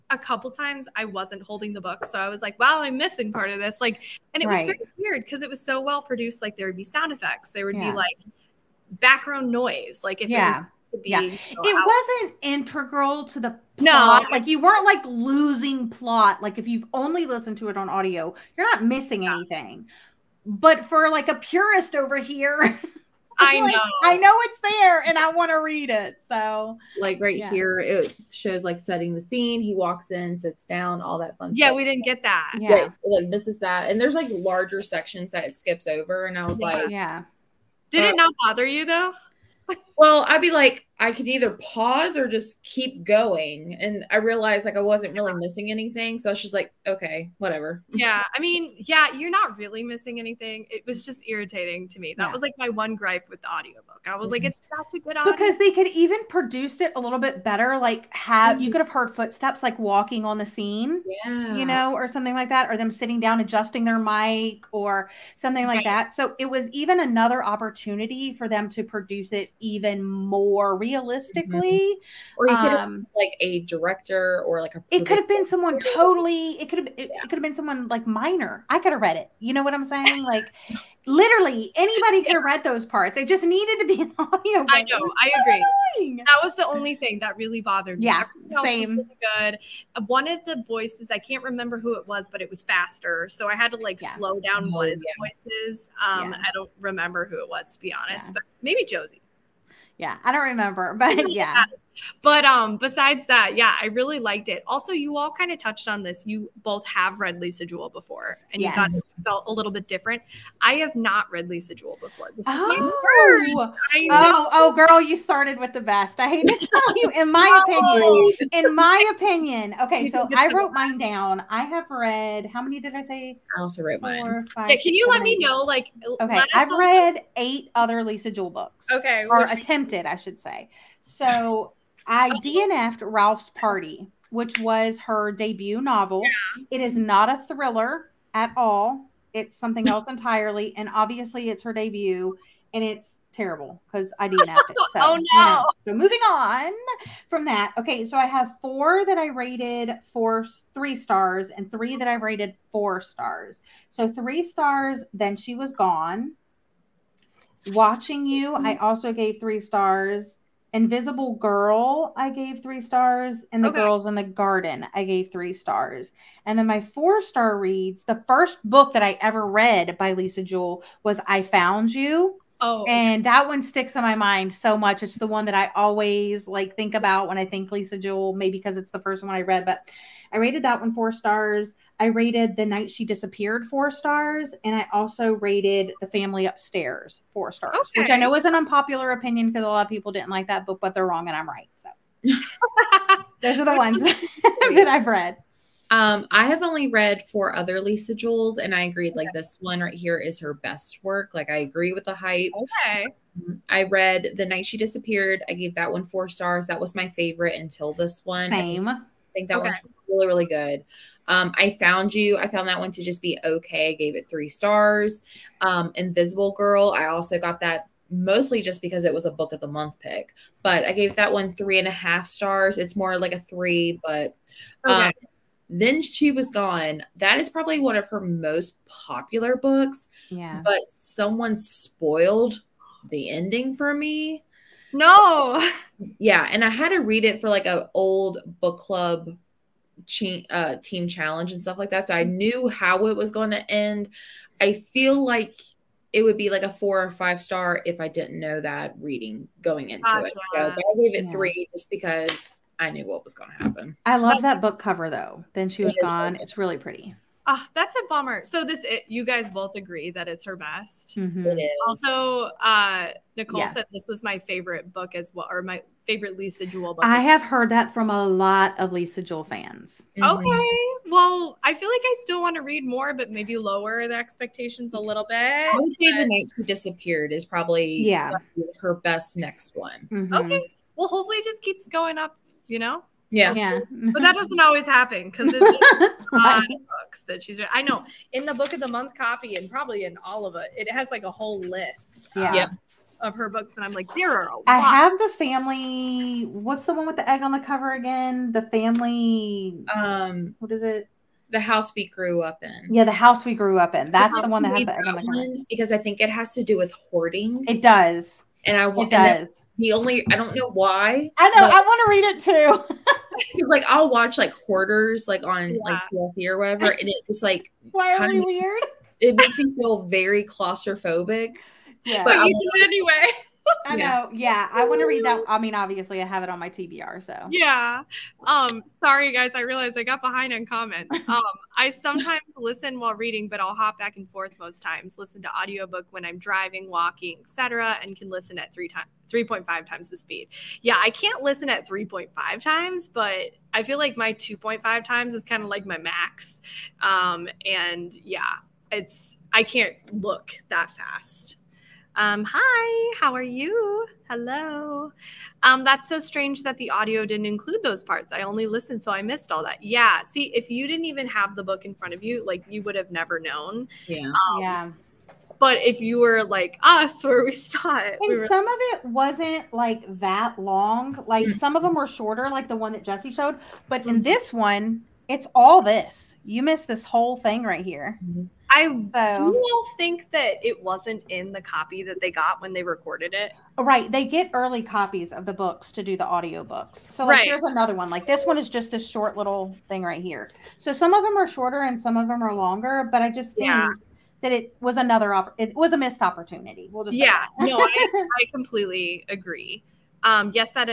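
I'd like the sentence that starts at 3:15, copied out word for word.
Um, I have only read four other Lisa Jewells, and I agreed okay.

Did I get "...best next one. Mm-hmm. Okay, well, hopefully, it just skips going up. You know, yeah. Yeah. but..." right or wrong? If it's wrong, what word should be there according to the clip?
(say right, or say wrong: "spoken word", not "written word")
wrong: "keeps", not "skips".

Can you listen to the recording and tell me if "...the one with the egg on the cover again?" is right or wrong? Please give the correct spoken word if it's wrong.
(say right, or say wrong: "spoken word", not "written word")
right.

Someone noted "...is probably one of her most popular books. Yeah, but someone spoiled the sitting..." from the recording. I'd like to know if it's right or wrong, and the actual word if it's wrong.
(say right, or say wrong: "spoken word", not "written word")
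wrong: "ending", not "sitting".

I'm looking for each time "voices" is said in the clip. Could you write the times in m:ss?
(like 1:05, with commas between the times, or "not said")
1:30, 1:35.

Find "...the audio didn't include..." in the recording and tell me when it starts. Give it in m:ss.
5:56.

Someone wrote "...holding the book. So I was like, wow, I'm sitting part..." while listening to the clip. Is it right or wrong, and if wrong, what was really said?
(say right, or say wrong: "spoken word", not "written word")
wrong: "missing", not "sitting".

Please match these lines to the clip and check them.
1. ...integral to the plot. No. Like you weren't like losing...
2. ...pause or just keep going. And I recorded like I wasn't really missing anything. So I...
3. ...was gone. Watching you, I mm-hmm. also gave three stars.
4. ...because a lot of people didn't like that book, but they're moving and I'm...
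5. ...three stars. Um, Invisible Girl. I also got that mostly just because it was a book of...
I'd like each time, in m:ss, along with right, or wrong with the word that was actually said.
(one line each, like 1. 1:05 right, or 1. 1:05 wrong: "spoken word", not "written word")
1. 0:12 right
2. 0:41 wrong: "realized", not "recorded"
3. 2:35 right
4. 3:09 wrong: "wrong", not "moving"
5. 3:34 right.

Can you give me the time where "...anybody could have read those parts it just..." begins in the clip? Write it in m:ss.
1:21.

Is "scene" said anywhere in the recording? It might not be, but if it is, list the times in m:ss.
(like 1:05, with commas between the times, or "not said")
0:29, 1:00.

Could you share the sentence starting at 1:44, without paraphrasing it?
Also, you all kind of touched on this.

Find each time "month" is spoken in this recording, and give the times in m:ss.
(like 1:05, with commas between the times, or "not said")
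3:39, 4:48.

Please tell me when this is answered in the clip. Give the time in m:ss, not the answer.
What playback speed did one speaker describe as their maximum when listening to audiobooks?
5:44.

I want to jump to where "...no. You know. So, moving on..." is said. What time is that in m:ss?
2:25.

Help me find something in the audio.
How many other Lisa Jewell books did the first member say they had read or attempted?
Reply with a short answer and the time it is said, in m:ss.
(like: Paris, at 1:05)
8, at 2:07.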